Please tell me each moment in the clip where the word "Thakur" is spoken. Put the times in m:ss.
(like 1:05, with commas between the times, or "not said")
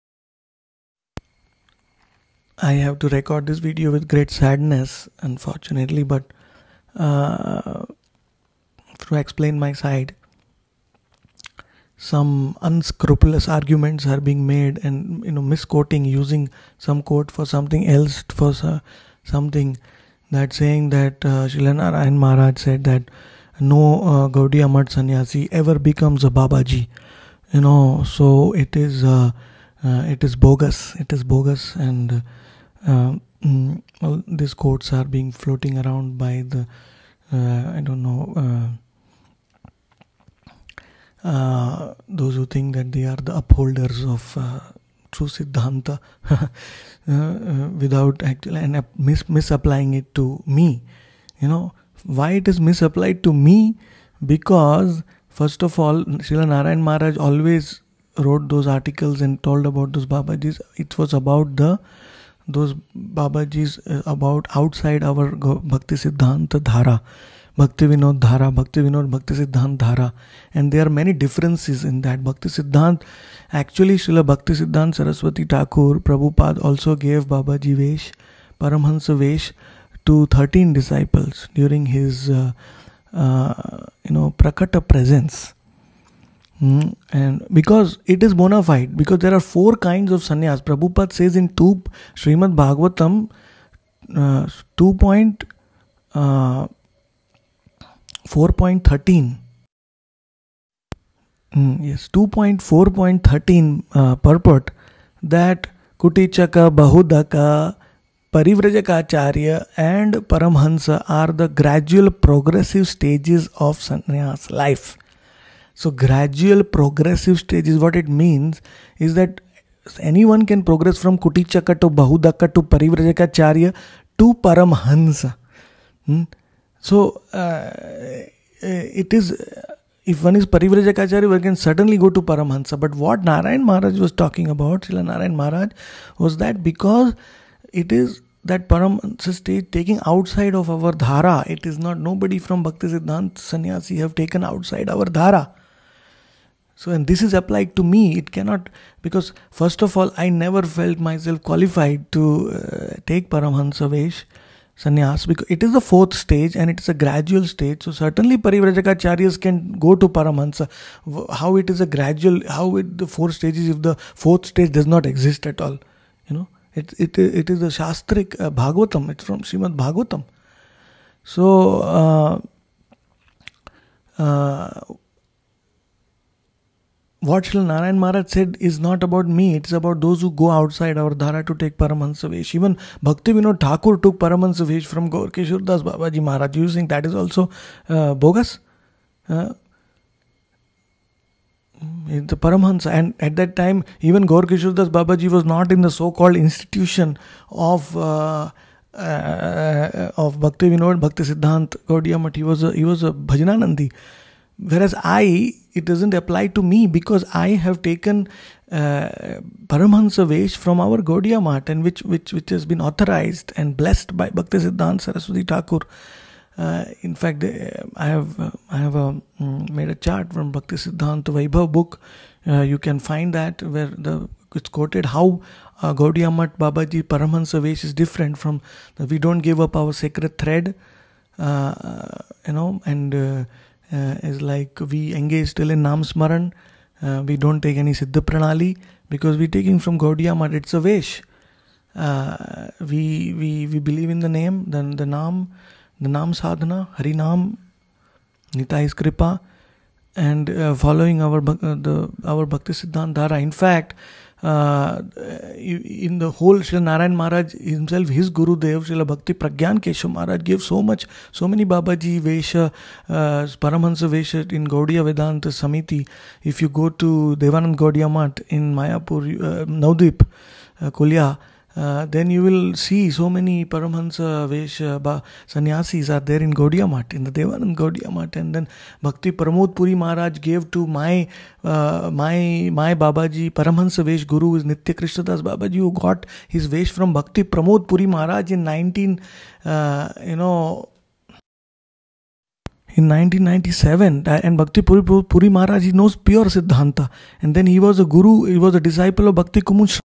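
1:15, 3:03, 3:35.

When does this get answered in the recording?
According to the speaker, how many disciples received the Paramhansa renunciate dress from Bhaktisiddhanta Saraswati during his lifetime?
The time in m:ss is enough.
1:20.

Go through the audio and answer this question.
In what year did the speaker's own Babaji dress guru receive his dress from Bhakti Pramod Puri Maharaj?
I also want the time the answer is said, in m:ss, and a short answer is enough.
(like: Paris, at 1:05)
1997, at 4:53.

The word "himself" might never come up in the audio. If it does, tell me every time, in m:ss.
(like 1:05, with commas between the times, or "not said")
4:17.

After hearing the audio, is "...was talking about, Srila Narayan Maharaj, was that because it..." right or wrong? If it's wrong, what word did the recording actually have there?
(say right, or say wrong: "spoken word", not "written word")
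right.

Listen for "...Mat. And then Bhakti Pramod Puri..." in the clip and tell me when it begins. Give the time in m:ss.
4:38.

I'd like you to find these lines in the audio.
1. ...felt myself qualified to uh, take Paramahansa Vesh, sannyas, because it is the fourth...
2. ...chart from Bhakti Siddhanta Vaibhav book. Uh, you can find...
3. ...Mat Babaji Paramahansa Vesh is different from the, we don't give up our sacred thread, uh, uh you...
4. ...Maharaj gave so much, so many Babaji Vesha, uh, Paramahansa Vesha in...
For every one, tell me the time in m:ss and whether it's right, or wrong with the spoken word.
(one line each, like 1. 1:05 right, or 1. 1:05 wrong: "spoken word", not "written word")
1. 2:30 right
2. 3:39 right
3. 3:46 right
4. 4:20 right.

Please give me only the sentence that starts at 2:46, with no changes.
It, it, it is the Shastric uh, Bhagavatam, it's from Srimad Bhagavatam.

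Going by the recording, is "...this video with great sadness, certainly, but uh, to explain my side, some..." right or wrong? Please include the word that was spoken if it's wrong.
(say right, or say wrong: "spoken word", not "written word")
wrong: "unfortunately", not "certainly".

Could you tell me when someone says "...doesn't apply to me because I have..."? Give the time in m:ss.
3:25.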